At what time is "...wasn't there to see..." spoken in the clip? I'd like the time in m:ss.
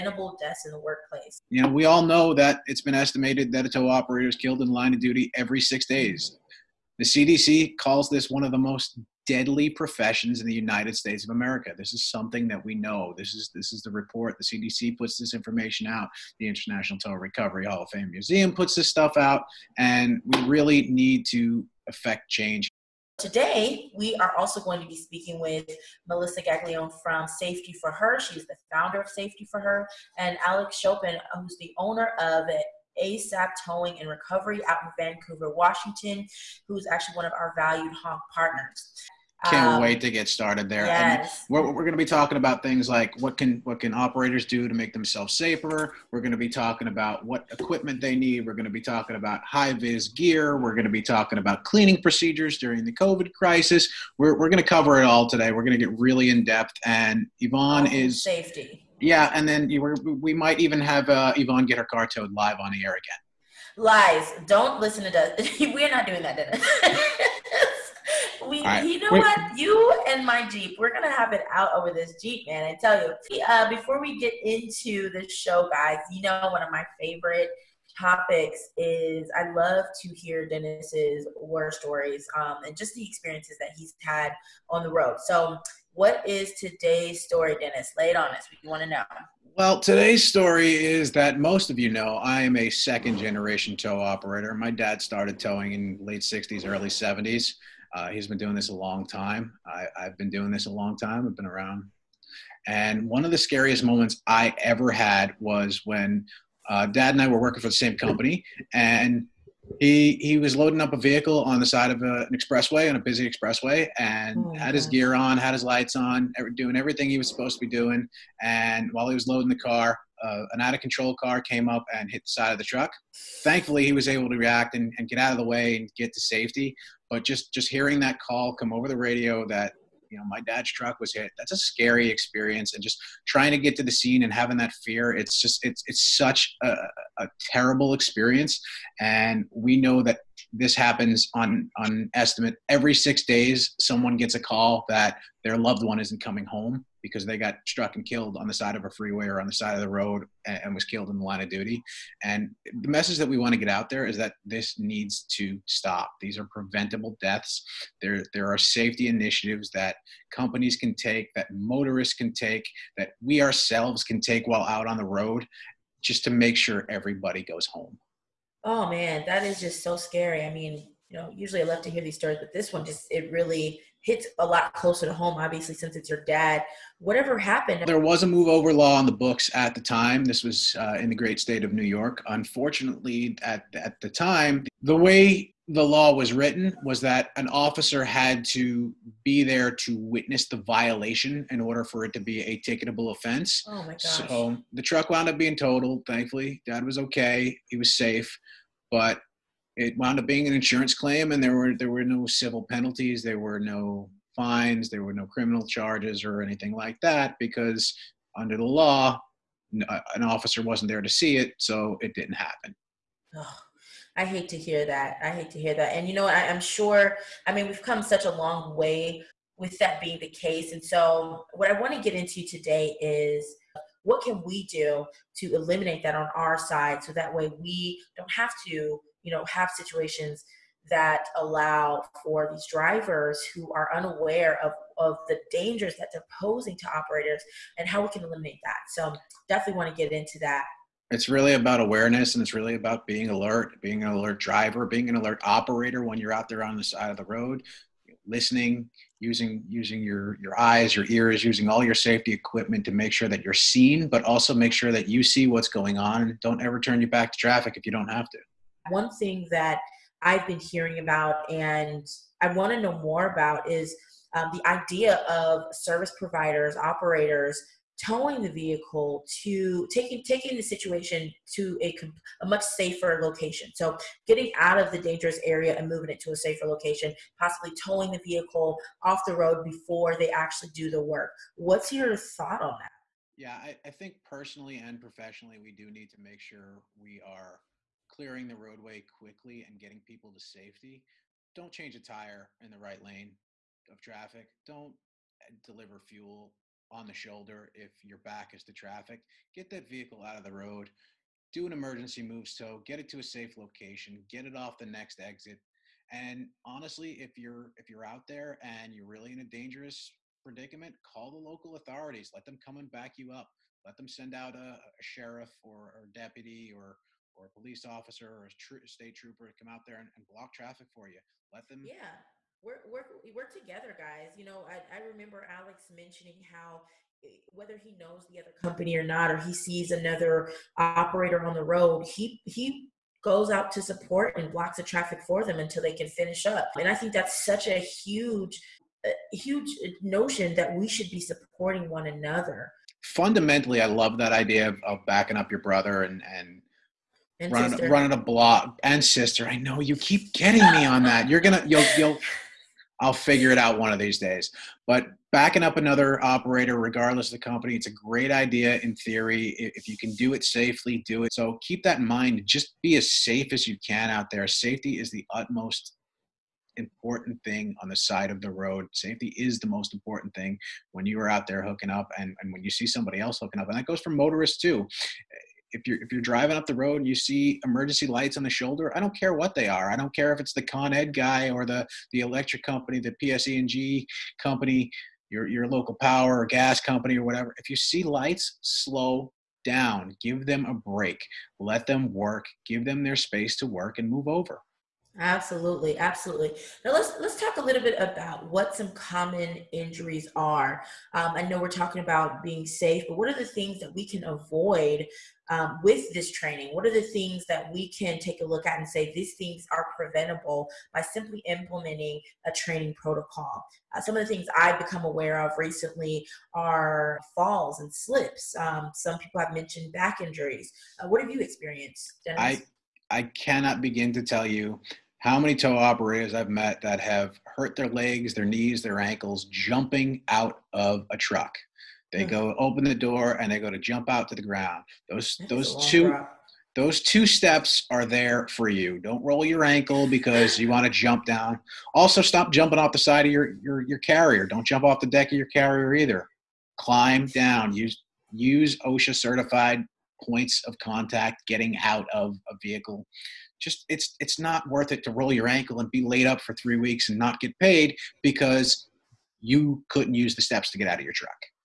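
3:30.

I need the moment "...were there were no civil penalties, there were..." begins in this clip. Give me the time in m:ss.
3:21.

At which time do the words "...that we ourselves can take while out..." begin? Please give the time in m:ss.
2:42.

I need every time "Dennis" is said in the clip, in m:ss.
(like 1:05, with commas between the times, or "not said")
1:20, 1:27, 7:02.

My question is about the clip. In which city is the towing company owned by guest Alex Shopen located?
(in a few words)
Vancouver, Washington.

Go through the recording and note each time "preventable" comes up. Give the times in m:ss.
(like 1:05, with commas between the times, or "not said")
2:36, 6:49.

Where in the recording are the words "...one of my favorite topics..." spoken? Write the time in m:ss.
1:16.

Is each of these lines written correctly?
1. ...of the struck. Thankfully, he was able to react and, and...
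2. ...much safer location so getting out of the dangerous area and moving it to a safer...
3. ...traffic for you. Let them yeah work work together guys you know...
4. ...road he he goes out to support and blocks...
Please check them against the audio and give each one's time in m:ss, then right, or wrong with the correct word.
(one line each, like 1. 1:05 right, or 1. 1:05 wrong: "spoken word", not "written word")
1. 2:02 wrong: "truck", not "struck"
2. 4:32 right
3. 5:20 right
4. 5:31 right.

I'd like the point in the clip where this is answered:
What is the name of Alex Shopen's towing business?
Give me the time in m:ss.
0:33.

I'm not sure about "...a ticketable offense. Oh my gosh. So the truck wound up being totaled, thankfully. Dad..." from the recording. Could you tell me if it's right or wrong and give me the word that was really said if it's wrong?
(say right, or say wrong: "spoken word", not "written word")
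right.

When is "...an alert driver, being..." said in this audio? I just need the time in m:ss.
4:04.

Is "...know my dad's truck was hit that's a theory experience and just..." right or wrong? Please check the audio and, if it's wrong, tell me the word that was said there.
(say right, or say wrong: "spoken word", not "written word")
wrong: "scary", not "theory".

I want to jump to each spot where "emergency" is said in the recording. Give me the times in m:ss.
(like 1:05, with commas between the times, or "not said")
5:01, 6:17.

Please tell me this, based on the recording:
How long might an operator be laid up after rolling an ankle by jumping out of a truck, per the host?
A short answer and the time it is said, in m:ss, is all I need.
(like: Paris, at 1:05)
3 weeks, at 7:36.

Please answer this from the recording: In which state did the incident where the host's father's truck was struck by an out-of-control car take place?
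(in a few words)
New York.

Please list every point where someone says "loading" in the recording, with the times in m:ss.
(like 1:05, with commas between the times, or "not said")
1:50, 1:59.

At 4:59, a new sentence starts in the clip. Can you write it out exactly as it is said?
Get that vehicle out of the road.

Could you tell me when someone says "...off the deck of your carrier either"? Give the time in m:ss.
7:24.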